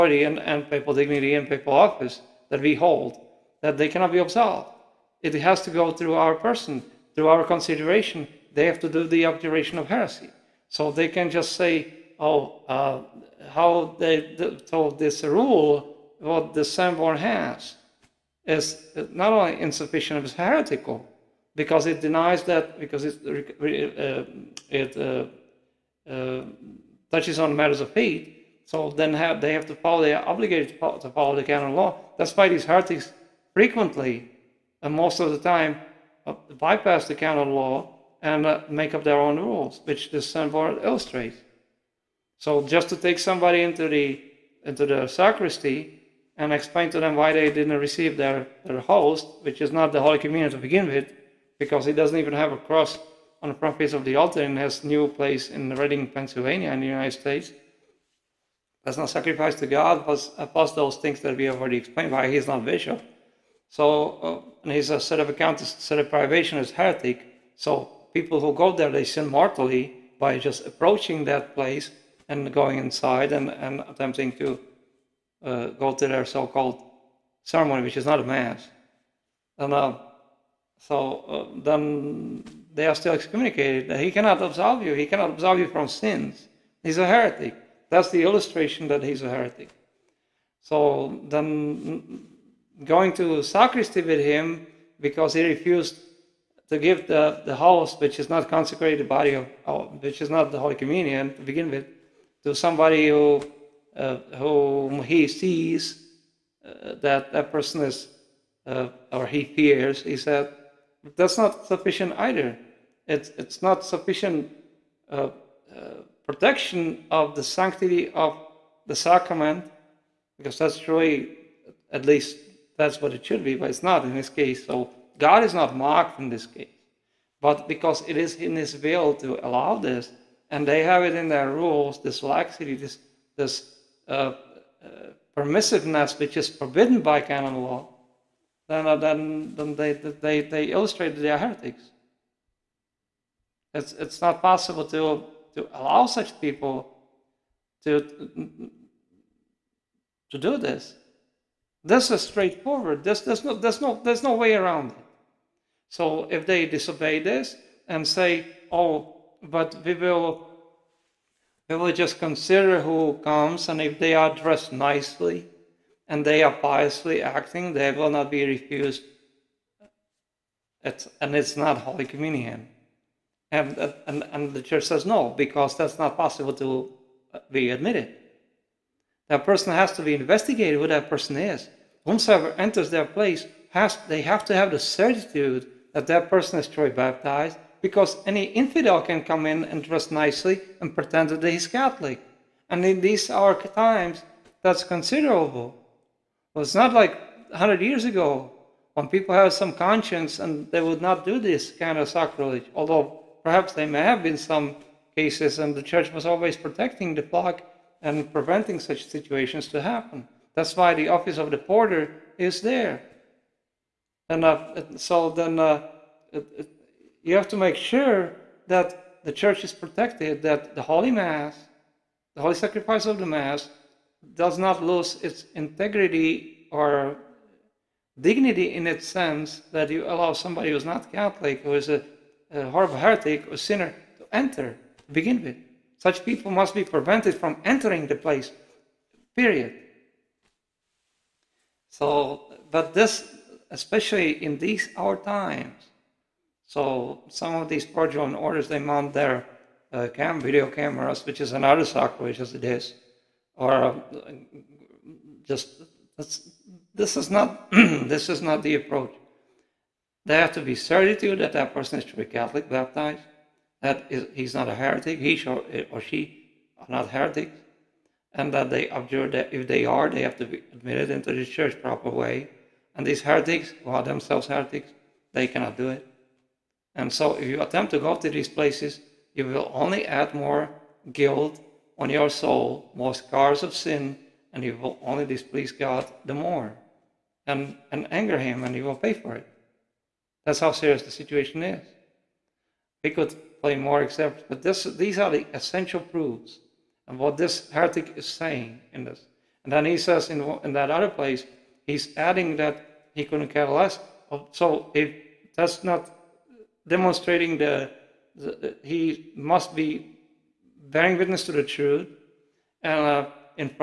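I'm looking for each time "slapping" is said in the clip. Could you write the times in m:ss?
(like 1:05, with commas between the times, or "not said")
not said.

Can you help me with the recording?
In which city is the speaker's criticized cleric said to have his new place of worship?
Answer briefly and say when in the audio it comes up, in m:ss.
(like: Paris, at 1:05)
Reading, Pennsylvania, at 0:55.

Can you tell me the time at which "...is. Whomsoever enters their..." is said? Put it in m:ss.
3:01.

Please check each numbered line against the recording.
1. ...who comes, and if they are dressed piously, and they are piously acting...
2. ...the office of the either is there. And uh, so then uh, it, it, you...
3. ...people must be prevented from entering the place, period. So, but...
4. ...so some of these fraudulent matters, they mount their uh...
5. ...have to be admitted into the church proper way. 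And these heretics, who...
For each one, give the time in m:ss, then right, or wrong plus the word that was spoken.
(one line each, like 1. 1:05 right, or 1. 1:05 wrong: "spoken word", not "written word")
1. 2:42 wrong: "nicely", not "piously"
2. 3:30 wrong: "porter", not "either"
3. 3:56 right
4. 4:06 wrong: "orders", not "matters"
5. 4:30 right.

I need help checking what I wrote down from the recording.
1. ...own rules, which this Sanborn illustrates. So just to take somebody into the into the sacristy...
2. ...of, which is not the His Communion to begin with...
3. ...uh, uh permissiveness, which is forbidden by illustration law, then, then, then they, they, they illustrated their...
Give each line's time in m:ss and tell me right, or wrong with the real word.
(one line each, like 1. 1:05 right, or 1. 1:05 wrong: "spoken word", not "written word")
1. 0:39 right
2. 1:39 wrong: "Holy", not "His"
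3. 2:14 wrong: "canon", not "illustration".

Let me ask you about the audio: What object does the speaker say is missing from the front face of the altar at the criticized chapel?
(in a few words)
a cross.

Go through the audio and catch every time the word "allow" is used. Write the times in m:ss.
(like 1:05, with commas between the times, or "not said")
2:09, 2:25, 3:50.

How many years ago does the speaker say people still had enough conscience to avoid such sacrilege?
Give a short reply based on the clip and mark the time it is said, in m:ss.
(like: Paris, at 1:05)
100, at 3:17.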